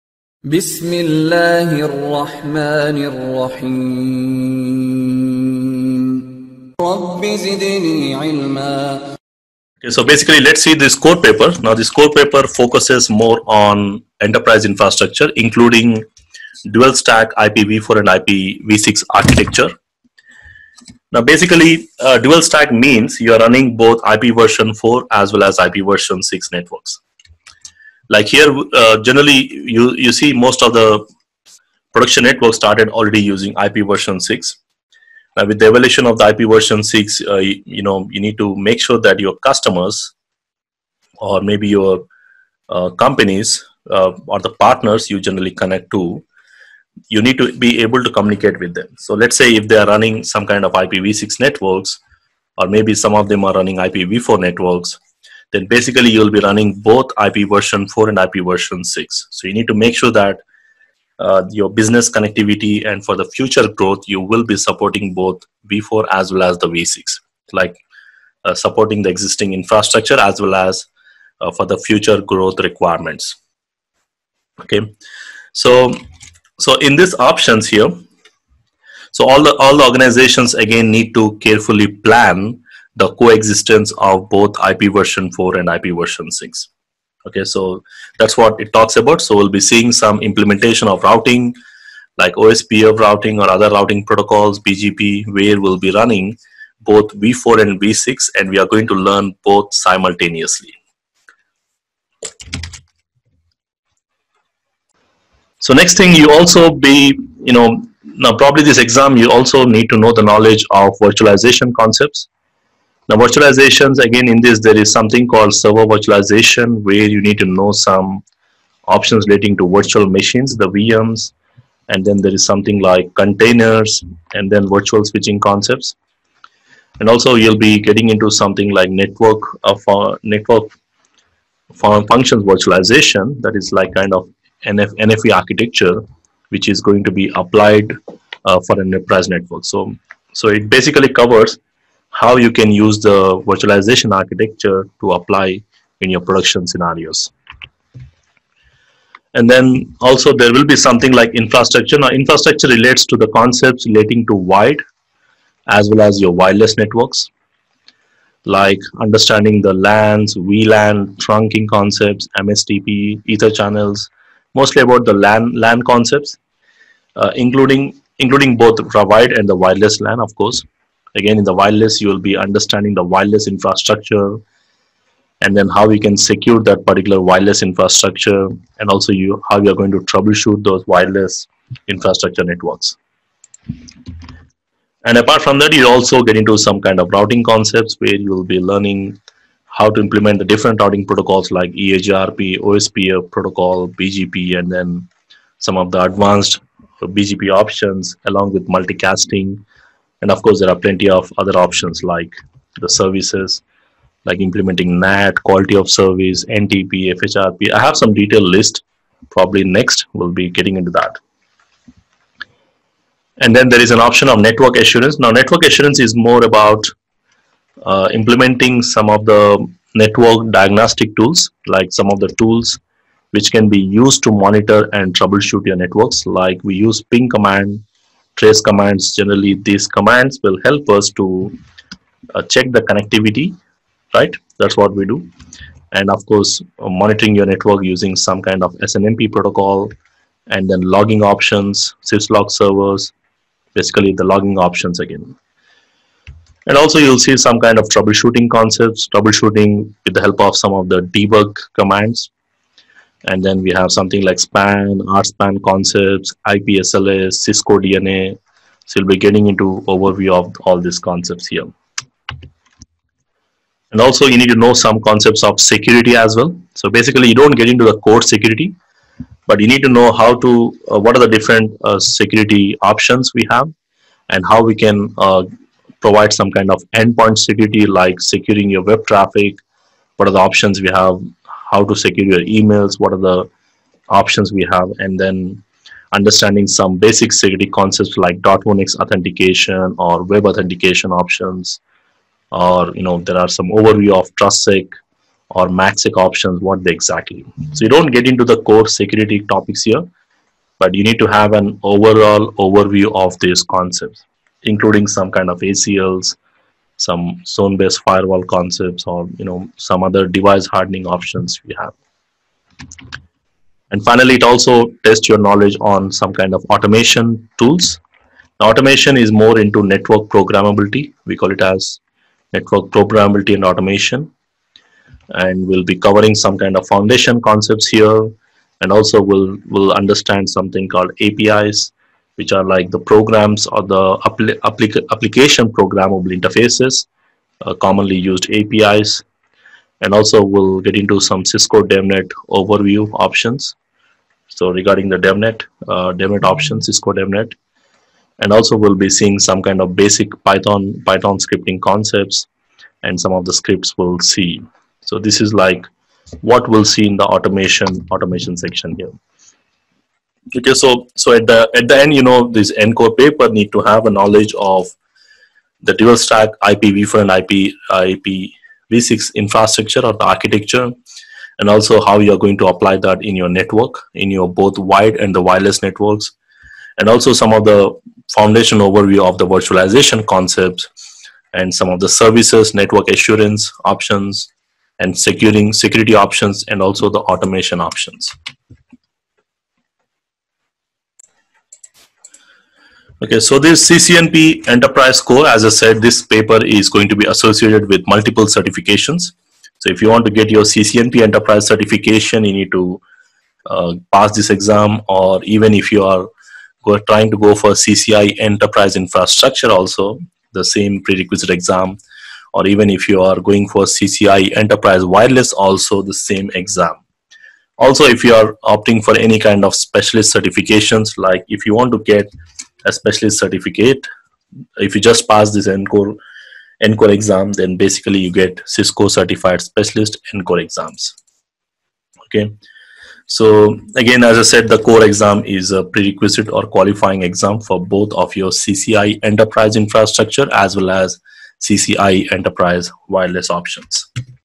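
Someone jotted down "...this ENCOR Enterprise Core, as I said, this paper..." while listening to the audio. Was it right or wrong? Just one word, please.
wrong.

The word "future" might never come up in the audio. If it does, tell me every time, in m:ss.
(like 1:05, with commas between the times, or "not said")
1:03, 1:11.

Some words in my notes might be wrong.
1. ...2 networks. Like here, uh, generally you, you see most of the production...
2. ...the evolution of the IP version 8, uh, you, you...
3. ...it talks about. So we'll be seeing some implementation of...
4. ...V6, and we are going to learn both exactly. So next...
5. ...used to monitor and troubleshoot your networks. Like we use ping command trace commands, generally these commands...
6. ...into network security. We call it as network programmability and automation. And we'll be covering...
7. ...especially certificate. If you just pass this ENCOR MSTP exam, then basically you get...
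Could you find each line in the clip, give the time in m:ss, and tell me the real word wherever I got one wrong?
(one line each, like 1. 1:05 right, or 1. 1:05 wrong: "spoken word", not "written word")
1. 0:26 wrong: "6", not "2"
2. 0:35 wrong: "6", not "8"
3. 1:28 right
4. 1:37 wrong: "simultaneously", not "exactly"
5. 3:43 right
6. 5:19 wrong: "programmability", not "security"
7. 7:02 wrong: "ENCOR", not "MSTP".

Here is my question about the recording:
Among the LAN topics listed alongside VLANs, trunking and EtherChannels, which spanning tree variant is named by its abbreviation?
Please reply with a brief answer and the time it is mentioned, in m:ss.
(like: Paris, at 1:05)
MSTP, at 2:42.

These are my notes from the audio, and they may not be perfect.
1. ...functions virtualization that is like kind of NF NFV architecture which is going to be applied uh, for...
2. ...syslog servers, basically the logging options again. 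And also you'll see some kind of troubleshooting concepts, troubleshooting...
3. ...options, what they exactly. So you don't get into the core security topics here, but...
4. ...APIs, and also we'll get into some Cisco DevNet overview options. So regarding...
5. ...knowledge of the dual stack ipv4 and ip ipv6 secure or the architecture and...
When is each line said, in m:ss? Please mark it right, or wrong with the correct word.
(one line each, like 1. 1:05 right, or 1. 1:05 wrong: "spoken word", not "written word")
1. 2:11 right
2. 4:02 right
3. 4:56 right
4. 5:38 right
5. 6:04 wrong: "infrastructure", not "secure".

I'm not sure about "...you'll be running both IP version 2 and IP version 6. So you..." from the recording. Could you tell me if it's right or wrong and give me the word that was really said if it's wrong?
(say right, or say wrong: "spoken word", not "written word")
wrong: "4", not "2".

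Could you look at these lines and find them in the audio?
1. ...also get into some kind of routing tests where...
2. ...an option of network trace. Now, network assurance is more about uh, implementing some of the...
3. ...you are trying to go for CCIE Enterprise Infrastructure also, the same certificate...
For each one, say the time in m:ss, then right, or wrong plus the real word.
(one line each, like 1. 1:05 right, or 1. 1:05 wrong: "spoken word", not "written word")
1. 3:05 wrong: "concepts", not "tests"
2. 3:33 wrong: "assurance", not "trace"
3. 6:45 wrong: "prerequisite", not "certificate".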